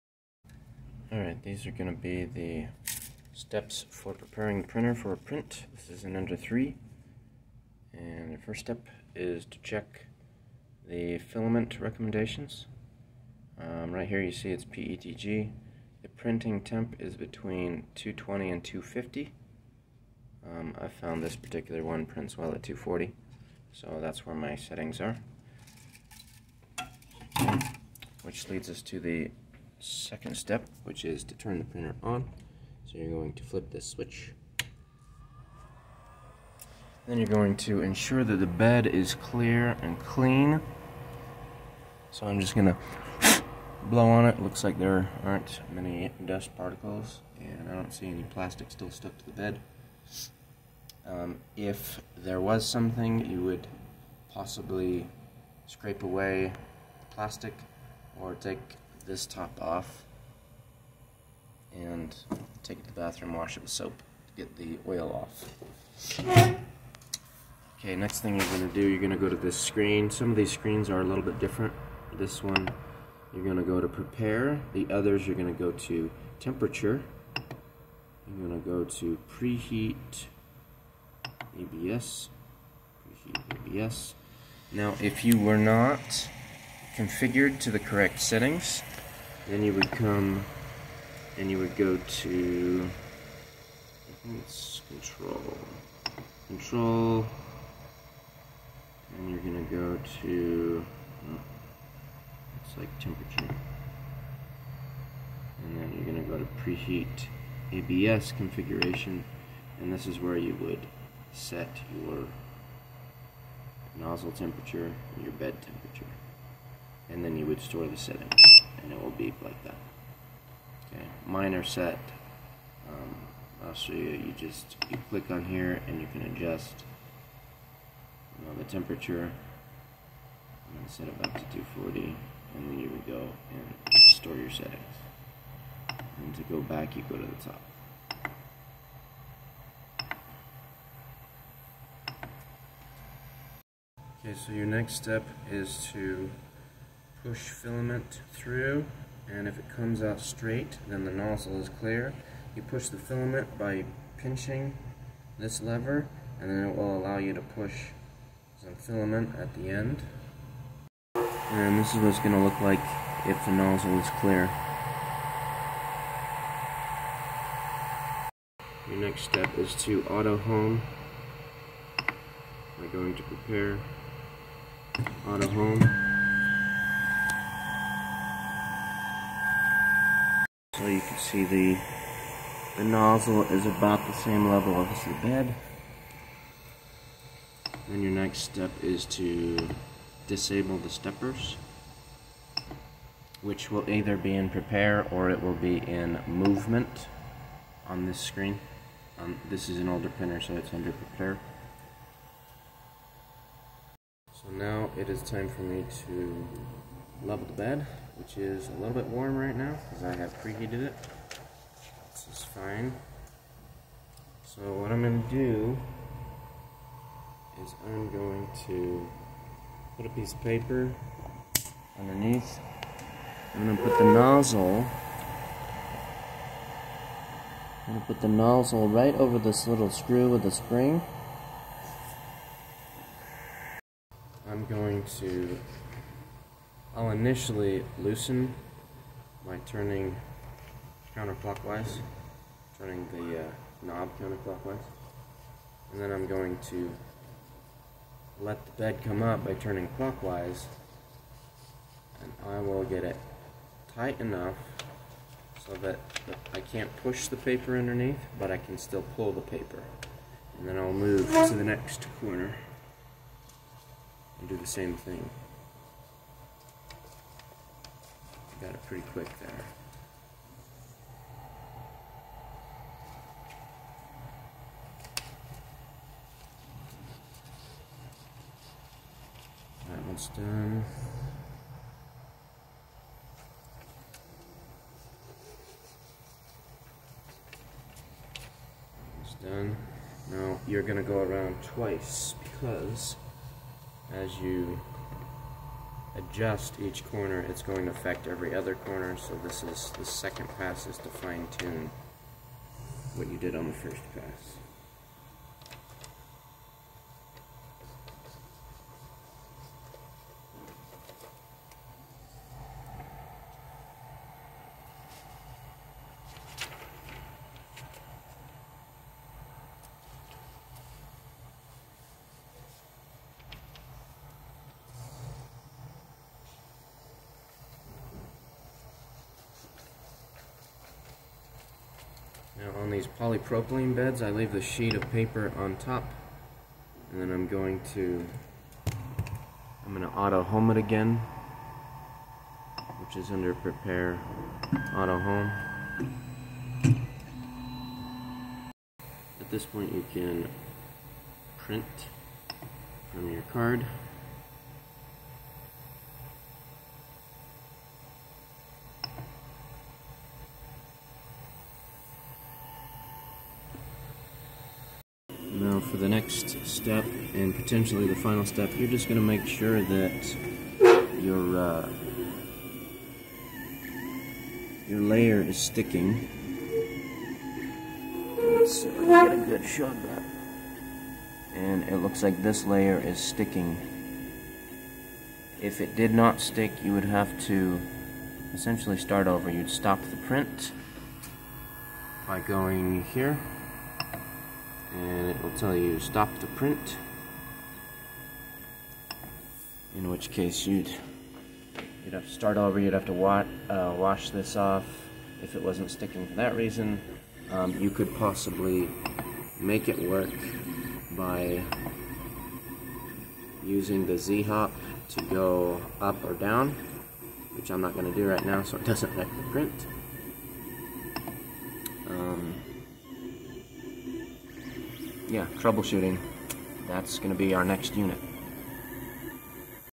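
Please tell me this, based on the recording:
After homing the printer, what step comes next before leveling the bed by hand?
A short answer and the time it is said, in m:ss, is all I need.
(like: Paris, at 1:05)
disable the steppers, at 3:10.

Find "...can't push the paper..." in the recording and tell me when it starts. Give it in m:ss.
4:16.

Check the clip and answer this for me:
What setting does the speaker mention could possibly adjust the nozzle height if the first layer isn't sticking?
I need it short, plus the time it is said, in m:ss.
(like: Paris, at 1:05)
z-hop, at 6:54.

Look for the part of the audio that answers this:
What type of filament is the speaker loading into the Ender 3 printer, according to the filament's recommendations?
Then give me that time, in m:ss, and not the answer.
0:14.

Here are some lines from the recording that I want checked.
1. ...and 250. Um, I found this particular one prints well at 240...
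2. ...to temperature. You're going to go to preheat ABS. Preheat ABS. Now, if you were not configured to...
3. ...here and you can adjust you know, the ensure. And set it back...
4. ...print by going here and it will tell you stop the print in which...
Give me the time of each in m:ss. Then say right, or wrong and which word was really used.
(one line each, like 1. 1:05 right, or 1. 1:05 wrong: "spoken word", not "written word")
1. 0:18 right
2. 1:15 right
3. 2:05 wrong: "temperature", not "ensure"
4. 6:30 right.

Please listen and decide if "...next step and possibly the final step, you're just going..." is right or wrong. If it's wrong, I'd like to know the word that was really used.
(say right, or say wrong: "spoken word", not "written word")
wrong: "potentially", not "possibly".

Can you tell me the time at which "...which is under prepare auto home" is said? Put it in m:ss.
5:43.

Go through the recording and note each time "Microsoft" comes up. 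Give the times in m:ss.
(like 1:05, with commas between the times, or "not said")
not said.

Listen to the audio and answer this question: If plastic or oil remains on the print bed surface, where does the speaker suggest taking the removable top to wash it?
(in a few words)
the bathroom.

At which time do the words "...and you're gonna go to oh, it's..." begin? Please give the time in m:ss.
1:39.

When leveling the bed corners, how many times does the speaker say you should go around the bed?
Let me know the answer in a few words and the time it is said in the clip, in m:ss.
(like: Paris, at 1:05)
twice, at 4:51.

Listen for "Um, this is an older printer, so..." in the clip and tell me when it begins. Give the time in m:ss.
3:19.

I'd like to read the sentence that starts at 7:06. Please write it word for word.
That's going to be our next unit.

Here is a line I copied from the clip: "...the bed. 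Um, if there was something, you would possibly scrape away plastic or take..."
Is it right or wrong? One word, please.
right.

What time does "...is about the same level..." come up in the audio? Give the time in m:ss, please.
3:03.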